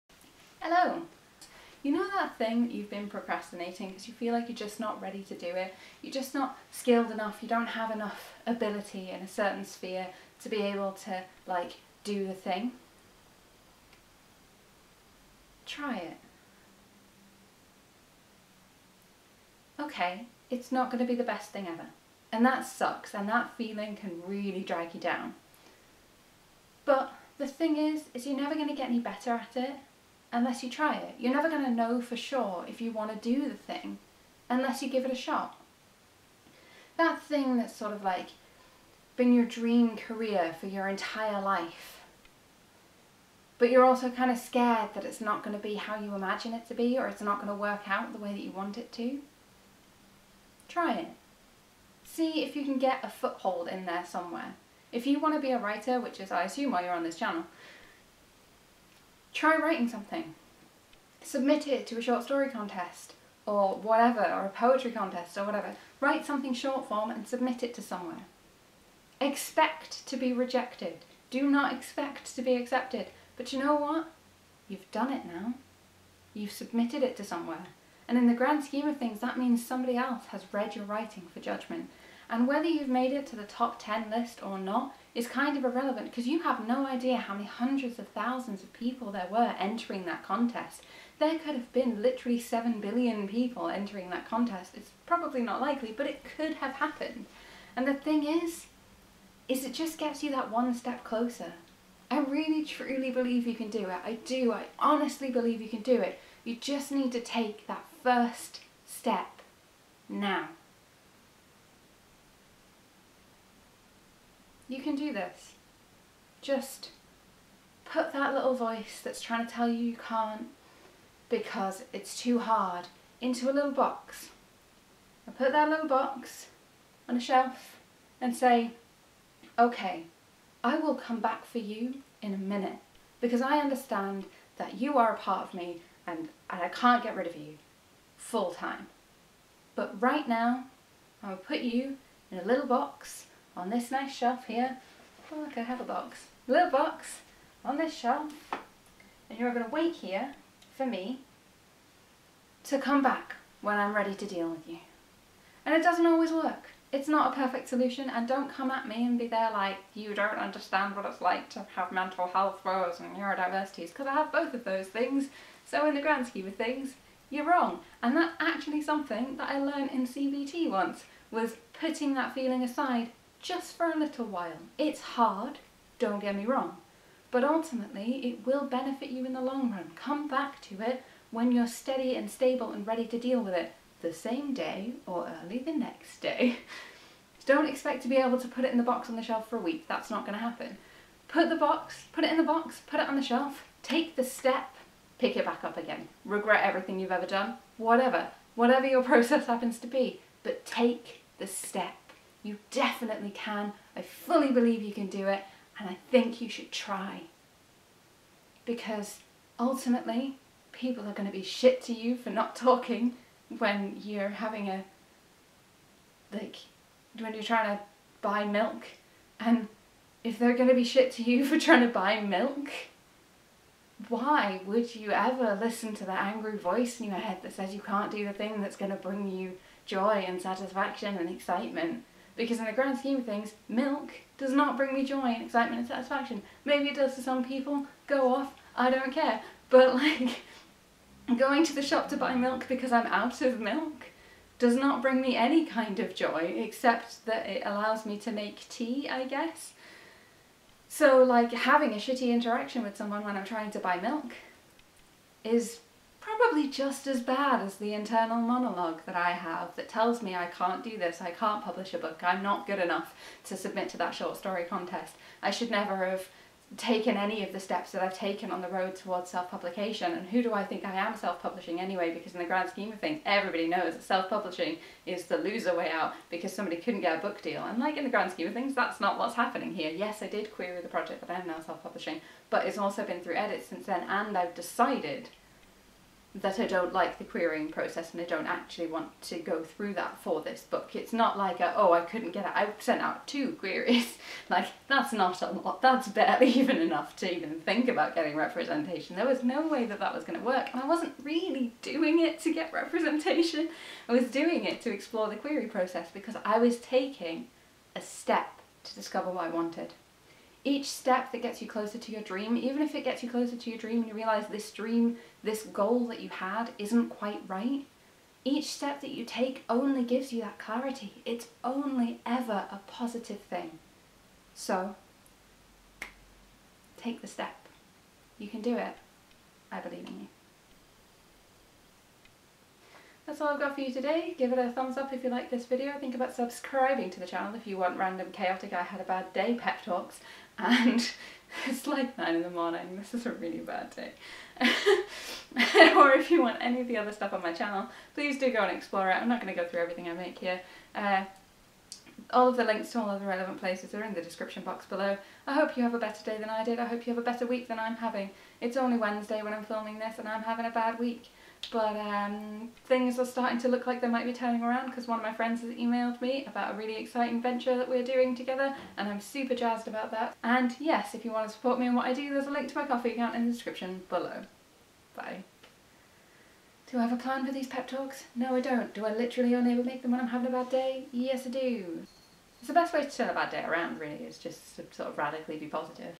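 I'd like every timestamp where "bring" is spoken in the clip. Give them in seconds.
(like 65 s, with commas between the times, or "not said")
228 s, 234 s, 245 s.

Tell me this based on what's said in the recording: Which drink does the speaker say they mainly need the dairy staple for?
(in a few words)
tea.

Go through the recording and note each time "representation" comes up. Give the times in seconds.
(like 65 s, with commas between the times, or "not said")
298 s, 302 s.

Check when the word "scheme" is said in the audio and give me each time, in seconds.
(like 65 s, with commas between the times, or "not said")
78 s, 166 s, 232 s, 272 s, 278 s.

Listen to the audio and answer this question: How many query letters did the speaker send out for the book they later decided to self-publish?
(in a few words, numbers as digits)
2.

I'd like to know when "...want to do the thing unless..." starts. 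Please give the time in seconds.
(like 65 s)
32 s.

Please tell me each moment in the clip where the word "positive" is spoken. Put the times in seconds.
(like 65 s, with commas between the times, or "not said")
322 s, 385 s.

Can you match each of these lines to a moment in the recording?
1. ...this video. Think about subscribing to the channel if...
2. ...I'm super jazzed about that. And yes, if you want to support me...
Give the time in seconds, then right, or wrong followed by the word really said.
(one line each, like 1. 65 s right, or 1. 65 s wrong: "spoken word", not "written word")
1. 335 s right
2. 369 s right.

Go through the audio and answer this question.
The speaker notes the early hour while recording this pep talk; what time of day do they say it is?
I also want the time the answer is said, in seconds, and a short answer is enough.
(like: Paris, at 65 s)
9 in the morning, at 342 s.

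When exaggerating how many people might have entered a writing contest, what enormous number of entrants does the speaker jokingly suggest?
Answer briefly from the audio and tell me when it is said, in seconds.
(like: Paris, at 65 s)
7 billion, at 92 s.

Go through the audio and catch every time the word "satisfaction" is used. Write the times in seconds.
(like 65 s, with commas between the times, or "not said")
230 s, 235 s.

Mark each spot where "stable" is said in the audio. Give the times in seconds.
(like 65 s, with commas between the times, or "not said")
182 s.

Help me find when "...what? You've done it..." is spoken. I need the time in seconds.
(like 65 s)
73 s.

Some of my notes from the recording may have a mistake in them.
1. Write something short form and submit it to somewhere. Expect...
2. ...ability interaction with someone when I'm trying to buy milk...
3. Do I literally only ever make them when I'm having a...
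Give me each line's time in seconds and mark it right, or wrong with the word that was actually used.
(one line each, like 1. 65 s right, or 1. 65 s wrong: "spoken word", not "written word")
1. 65 s right
2. 251 s wrong: "shitty", not "ability"
3. 378 s right.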